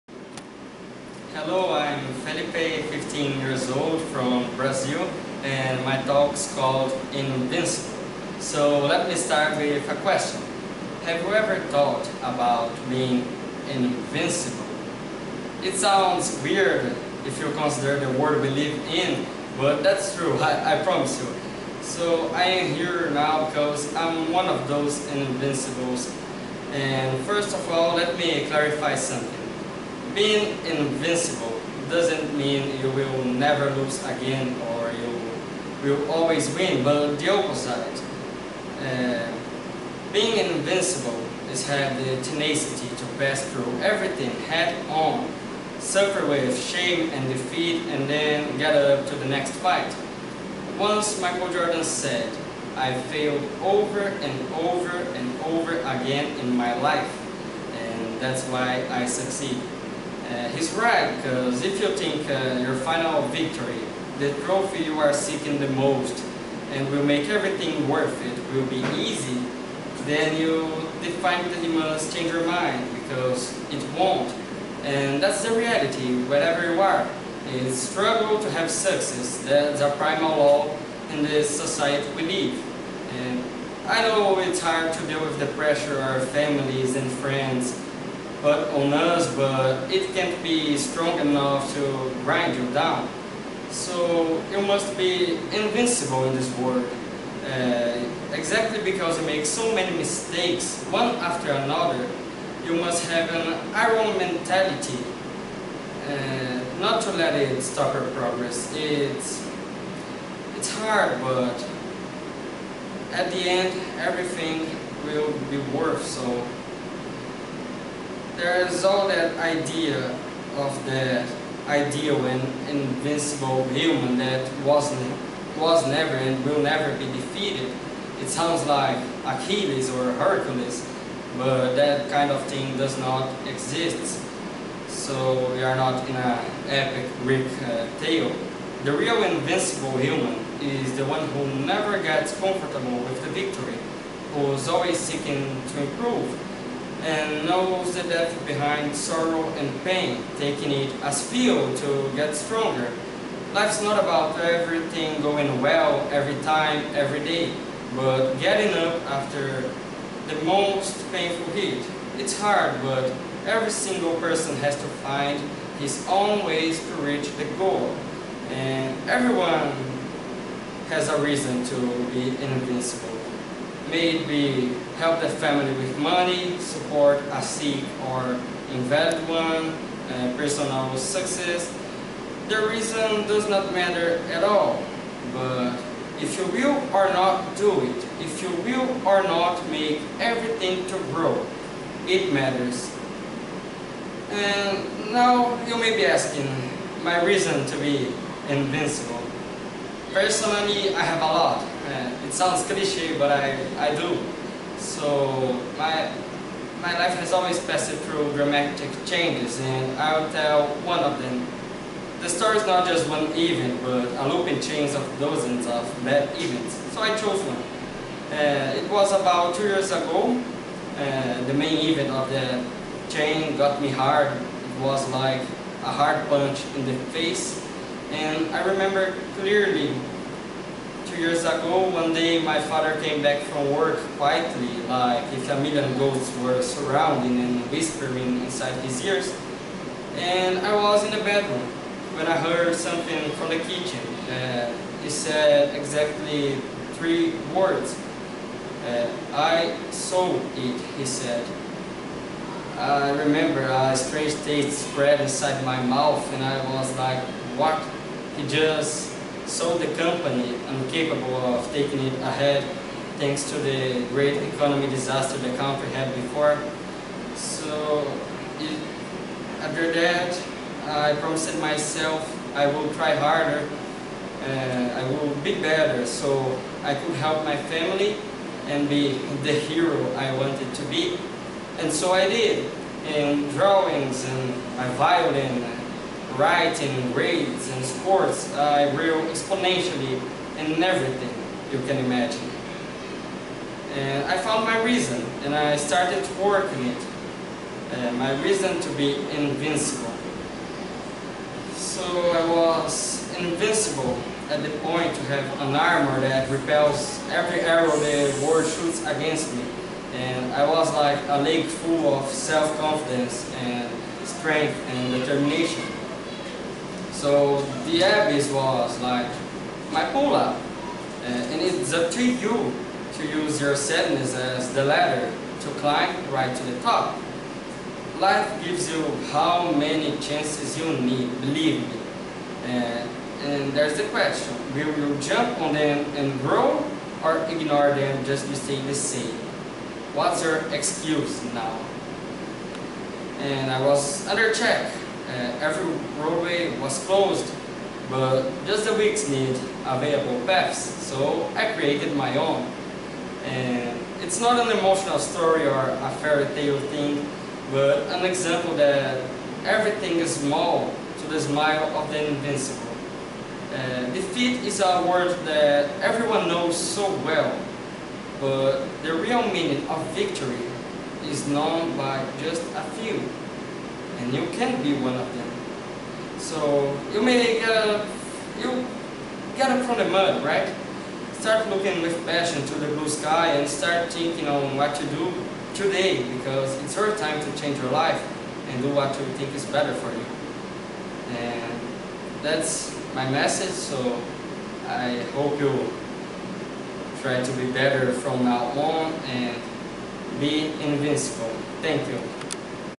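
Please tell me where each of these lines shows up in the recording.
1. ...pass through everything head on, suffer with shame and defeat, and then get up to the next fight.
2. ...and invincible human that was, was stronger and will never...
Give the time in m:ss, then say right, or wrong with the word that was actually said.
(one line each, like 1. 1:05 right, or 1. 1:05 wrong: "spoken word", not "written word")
1. 0:43 right
2. 2:02 wrong: "never", not "stronger".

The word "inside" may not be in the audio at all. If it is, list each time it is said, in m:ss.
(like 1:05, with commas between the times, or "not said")
3:58, 4:15.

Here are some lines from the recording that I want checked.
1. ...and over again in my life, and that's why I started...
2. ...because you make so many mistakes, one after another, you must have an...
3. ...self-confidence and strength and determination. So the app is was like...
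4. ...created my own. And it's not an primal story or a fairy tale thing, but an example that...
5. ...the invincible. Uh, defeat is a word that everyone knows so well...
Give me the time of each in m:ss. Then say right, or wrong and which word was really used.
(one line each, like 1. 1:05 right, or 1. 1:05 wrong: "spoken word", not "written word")
1. 0:54 wrong: "succeed", not "started"
2. 1:38 right
3. 5:12 right
4. 5:51 wrong: "emotional", not "primal"
5. 6:02 right.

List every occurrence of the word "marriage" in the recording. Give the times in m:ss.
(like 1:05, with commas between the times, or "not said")
not said.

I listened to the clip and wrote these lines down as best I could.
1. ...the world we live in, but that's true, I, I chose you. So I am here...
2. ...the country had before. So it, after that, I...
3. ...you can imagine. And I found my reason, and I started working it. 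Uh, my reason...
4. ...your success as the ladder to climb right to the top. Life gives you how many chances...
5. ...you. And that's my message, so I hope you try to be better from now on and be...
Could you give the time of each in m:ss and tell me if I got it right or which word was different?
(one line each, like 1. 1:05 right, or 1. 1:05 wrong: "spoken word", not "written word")
1. 0:18 wrong: "promise", not "chose"
2. 4:25 right
3. 4:51 right
4. 5:23 wrong: "sadness", not "success"
5. 6:30 right.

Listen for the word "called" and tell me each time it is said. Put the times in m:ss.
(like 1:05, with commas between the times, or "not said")
0:06.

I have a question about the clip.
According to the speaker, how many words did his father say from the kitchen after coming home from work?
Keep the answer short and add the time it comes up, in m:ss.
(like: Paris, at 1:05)
3, at 4:06.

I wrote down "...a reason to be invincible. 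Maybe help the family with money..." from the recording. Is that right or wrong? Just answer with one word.
right.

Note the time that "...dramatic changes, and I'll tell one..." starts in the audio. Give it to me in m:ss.
3:28.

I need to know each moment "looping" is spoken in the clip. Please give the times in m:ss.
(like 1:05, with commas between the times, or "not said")
3:34.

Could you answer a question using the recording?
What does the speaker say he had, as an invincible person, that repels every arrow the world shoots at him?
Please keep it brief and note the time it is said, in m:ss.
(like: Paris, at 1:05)
an armor, at 5:05.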